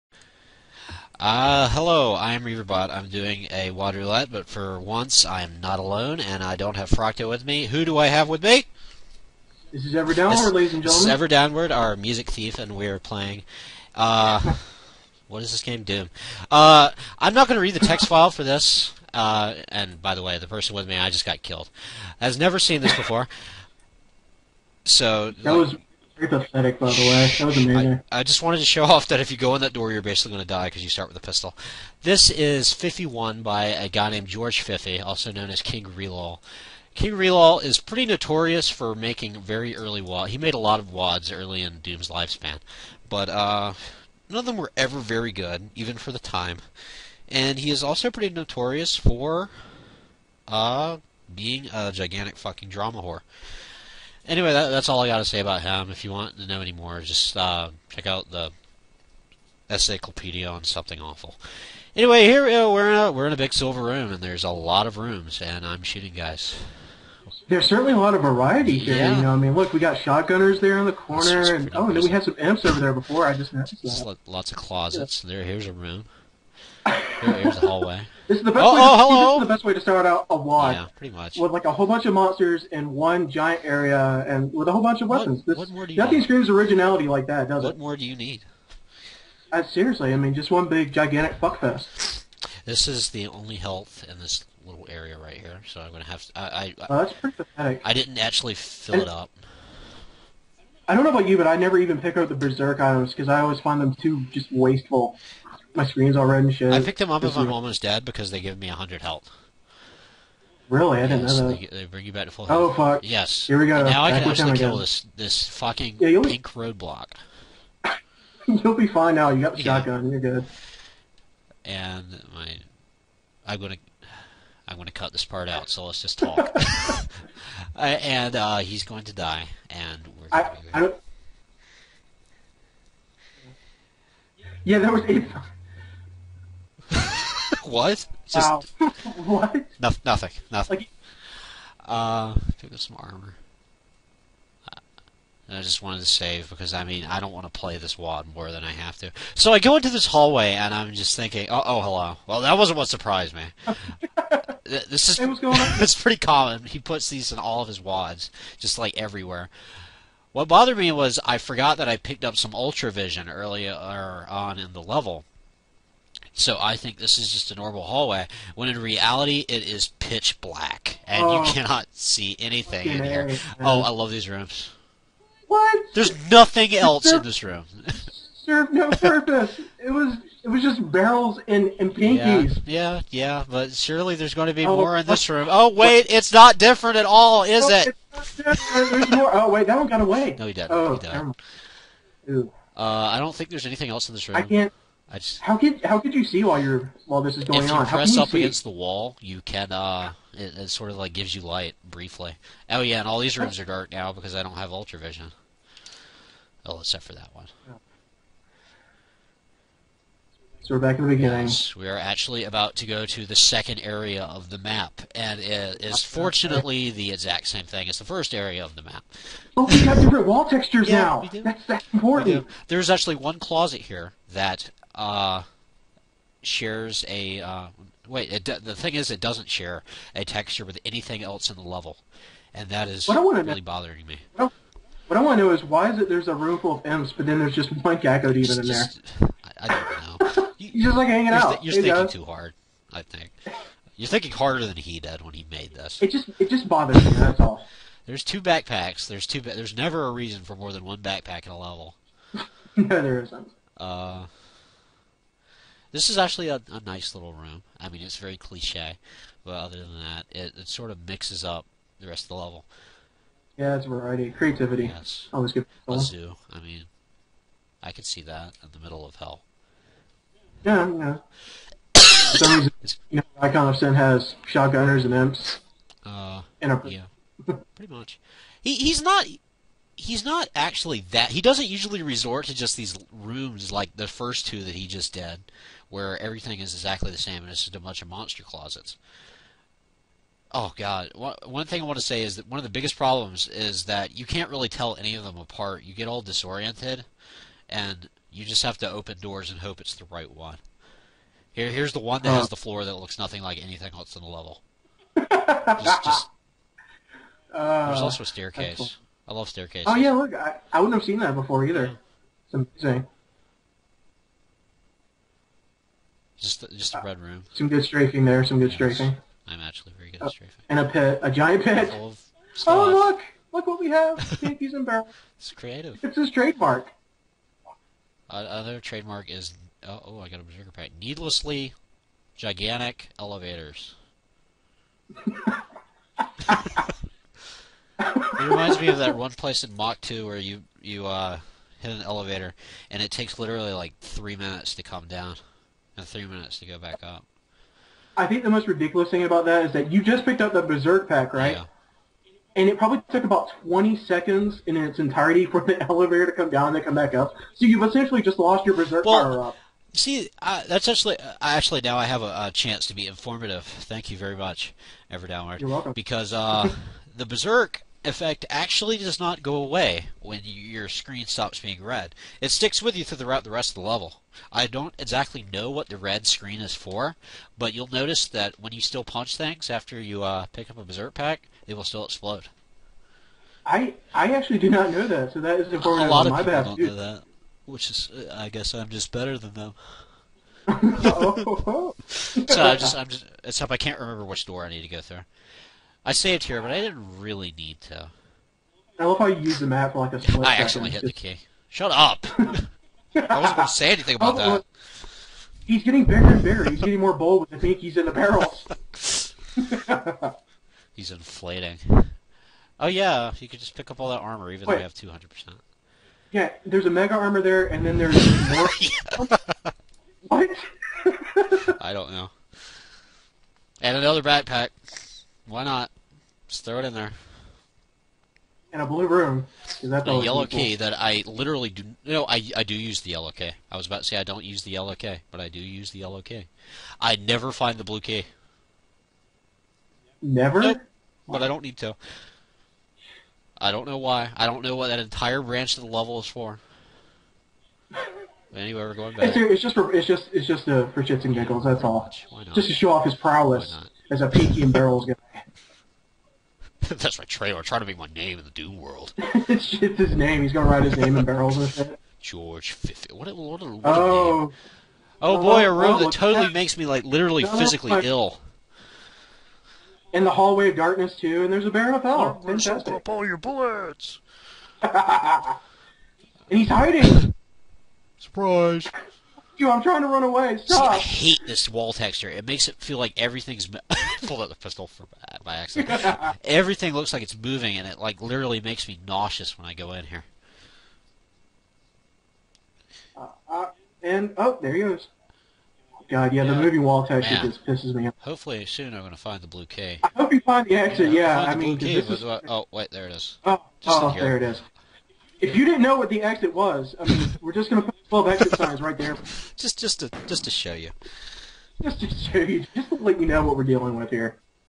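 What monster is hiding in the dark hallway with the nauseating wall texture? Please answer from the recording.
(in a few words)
Baron of Hell.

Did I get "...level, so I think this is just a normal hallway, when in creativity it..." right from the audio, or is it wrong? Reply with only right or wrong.
wrong.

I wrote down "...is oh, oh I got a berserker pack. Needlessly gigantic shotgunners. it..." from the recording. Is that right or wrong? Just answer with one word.
wrong.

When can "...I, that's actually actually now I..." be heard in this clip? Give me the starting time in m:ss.
6:00.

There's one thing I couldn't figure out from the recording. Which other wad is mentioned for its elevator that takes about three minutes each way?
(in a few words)
Mach 2.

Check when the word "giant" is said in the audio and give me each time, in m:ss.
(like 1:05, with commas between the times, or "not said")
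1:23, 5:21.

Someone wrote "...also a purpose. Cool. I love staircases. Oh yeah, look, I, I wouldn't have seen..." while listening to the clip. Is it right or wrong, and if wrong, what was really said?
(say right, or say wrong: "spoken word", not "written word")
wrong: "staircase", not "purpose".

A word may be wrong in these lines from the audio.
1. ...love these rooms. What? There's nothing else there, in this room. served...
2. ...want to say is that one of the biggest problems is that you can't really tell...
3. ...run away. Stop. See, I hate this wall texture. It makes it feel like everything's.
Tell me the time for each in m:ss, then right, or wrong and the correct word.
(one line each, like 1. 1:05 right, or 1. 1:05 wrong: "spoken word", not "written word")
1. 2:53 right
2. 4:51 right
3. 8:00 right.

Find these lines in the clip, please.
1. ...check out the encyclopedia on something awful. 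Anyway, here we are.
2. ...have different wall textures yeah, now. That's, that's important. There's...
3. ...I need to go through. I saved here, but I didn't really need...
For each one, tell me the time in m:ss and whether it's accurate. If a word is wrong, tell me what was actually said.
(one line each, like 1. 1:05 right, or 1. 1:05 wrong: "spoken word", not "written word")
1. 0:57 right
2. 3:39 right
3. 6:34 right.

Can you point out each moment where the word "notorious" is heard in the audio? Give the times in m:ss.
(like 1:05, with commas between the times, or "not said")
0:38, 0:48.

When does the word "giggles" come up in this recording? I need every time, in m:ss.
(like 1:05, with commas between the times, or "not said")
7:31.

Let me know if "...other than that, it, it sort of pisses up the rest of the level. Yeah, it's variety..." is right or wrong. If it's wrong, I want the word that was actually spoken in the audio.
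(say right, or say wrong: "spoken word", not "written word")
wrong: "mixes", not "pisses".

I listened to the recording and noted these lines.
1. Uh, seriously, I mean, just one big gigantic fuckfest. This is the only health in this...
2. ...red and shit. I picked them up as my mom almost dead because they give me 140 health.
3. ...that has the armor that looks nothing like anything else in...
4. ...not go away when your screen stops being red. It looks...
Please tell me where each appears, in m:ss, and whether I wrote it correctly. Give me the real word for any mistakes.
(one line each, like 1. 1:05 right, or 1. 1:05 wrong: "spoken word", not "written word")
1. 1:29 right
2. 1:46 wrong: "100", not "140"
3. 5:02 wrong: "floor", not "armor"
4. 6:09 wrong: "sticks", not "looks".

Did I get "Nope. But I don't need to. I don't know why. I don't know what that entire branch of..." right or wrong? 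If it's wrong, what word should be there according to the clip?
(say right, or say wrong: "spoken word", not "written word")
right.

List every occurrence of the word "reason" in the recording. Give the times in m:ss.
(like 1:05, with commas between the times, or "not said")
4:10, 4:32.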